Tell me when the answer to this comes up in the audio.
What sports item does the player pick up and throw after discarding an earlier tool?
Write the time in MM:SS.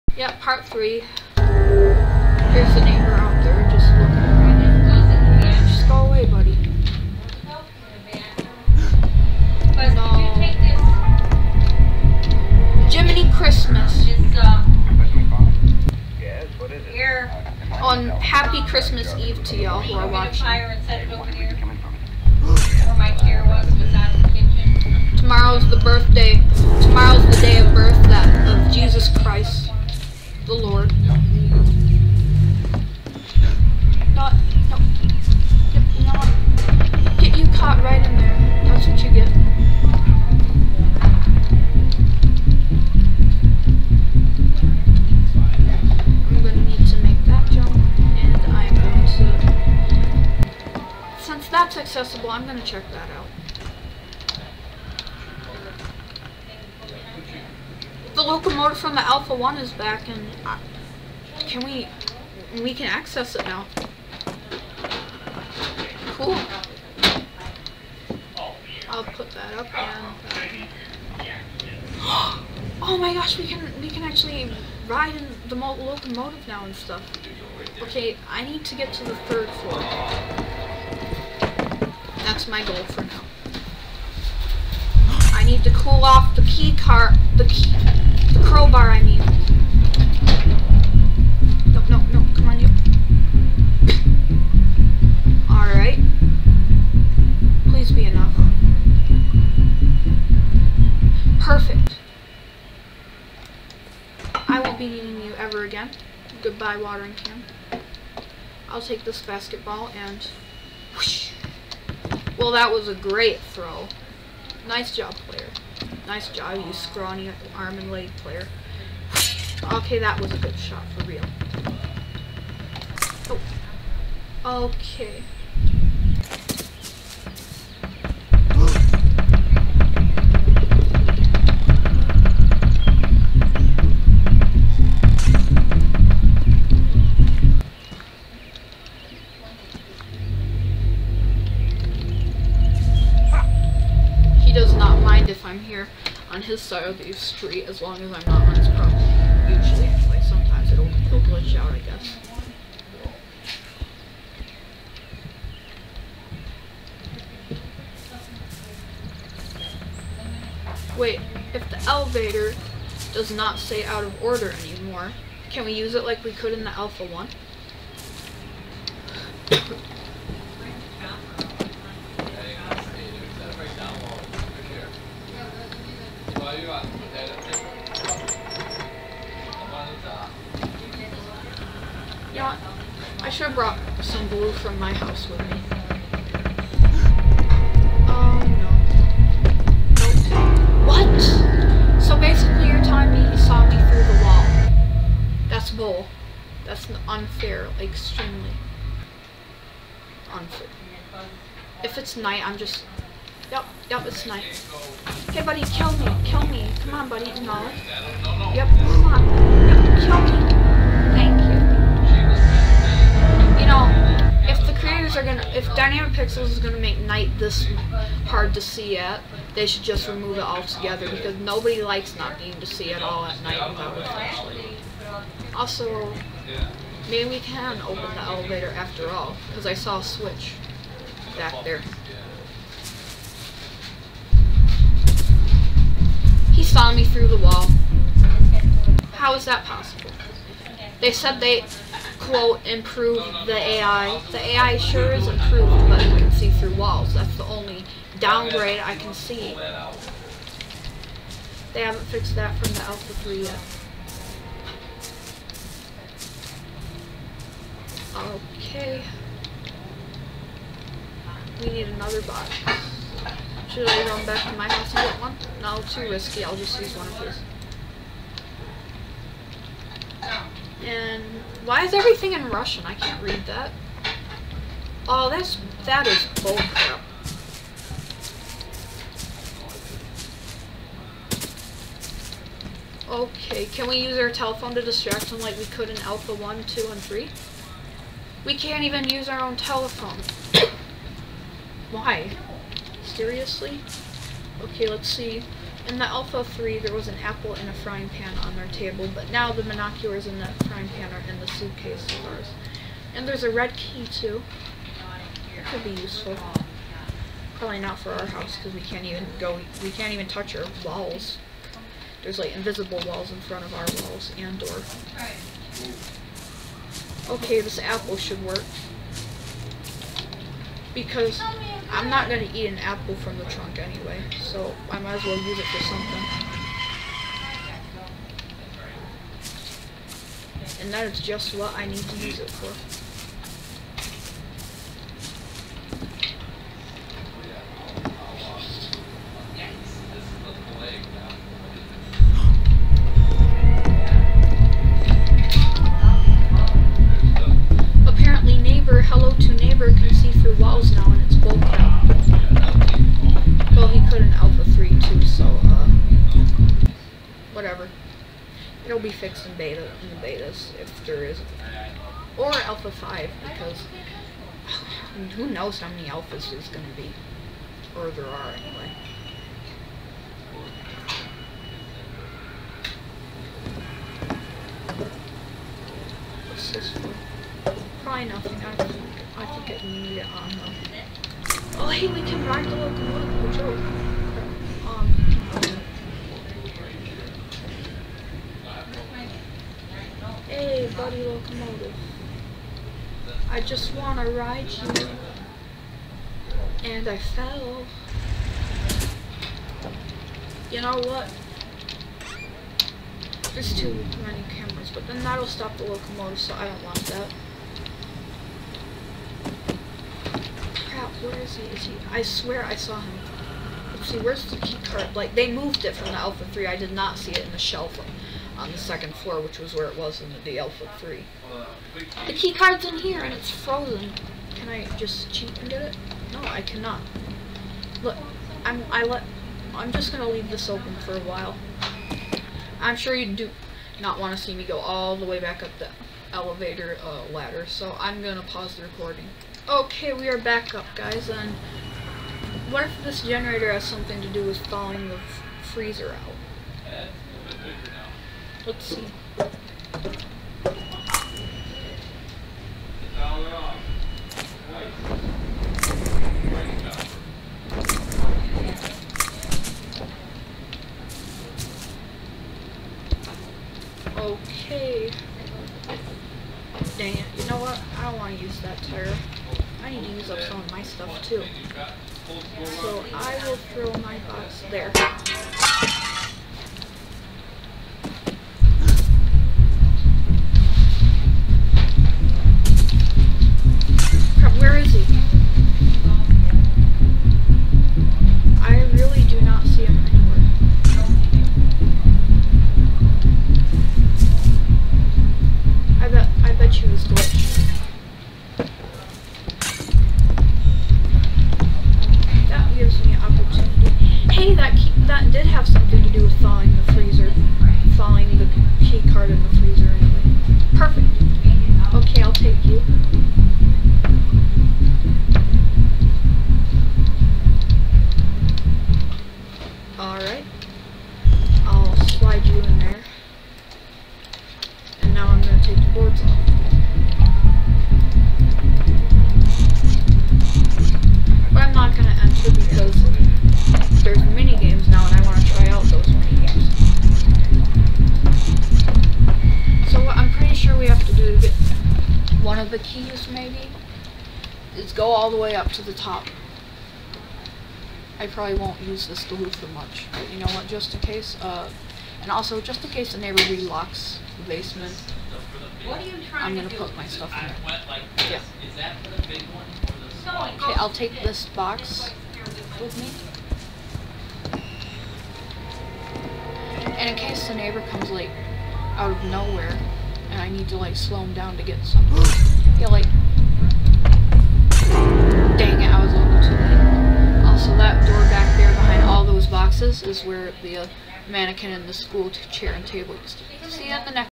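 01:49.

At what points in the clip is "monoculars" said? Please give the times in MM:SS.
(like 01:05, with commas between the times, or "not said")
04:59.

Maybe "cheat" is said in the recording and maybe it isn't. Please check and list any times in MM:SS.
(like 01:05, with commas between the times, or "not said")
07:05.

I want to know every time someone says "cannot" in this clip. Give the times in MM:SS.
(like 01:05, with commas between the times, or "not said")
07:06.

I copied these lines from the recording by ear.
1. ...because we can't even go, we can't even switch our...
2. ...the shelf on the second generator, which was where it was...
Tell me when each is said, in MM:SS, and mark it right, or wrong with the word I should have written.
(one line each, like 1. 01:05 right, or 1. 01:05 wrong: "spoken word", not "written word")
1. 05:08 wrong: "touch", not "switch"
2. 06:57 wrong: "floor", not "generator".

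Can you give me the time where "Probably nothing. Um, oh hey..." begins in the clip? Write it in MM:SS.
06:18.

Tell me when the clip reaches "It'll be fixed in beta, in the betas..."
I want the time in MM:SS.
05:58.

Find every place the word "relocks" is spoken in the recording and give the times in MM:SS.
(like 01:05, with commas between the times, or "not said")
09:13.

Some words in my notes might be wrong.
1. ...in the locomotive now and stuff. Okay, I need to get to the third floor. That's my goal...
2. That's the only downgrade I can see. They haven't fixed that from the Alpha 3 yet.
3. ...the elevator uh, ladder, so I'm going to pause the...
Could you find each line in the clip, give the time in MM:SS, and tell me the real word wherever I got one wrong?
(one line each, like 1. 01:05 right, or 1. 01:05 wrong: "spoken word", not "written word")
1. 01:15 right
2. 04:07 right
3. 07:15 right.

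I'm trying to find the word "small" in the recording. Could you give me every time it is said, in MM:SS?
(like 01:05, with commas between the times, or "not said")
09:20.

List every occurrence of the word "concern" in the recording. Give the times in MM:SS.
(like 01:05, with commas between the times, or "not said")
not said.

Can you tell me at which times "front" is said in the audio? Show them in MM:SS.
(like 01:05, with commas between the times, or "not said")
05:13.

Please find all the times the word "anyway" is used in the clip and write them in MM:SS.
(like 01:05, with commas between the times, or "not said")
05:23, 06:08.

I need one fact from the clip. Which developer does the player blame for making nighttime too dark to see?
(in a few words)
Dynamic Pixels.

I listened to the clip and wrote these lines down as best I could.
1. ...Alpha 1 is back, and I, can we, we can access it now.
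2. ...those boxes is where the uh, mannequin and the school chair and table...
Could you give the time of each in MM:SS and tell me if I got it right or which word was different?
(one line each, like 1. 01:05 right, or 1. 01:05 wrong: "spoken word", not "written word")
1. 00:59 right
2. 09:39 right.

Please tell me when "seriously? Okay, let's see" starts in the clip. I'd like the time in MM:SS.
04:53.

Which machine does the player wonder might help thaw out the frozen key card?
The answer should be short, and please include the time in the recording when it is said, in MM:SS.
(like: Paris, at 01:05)
Generator, at 07:23.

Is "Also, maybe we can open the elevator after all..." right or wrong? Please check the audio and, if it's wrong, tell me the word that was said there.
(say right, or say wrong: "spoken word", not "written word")
right.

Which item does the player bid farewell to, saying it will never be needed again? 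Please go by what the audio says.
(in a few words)
Watering can.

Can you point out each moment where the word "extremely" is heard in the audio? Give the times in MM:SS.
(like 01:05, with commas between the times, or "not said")
03:17.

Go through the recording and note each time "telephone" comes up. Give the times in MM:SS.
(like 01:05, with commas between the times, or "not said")
04:44, 04:49.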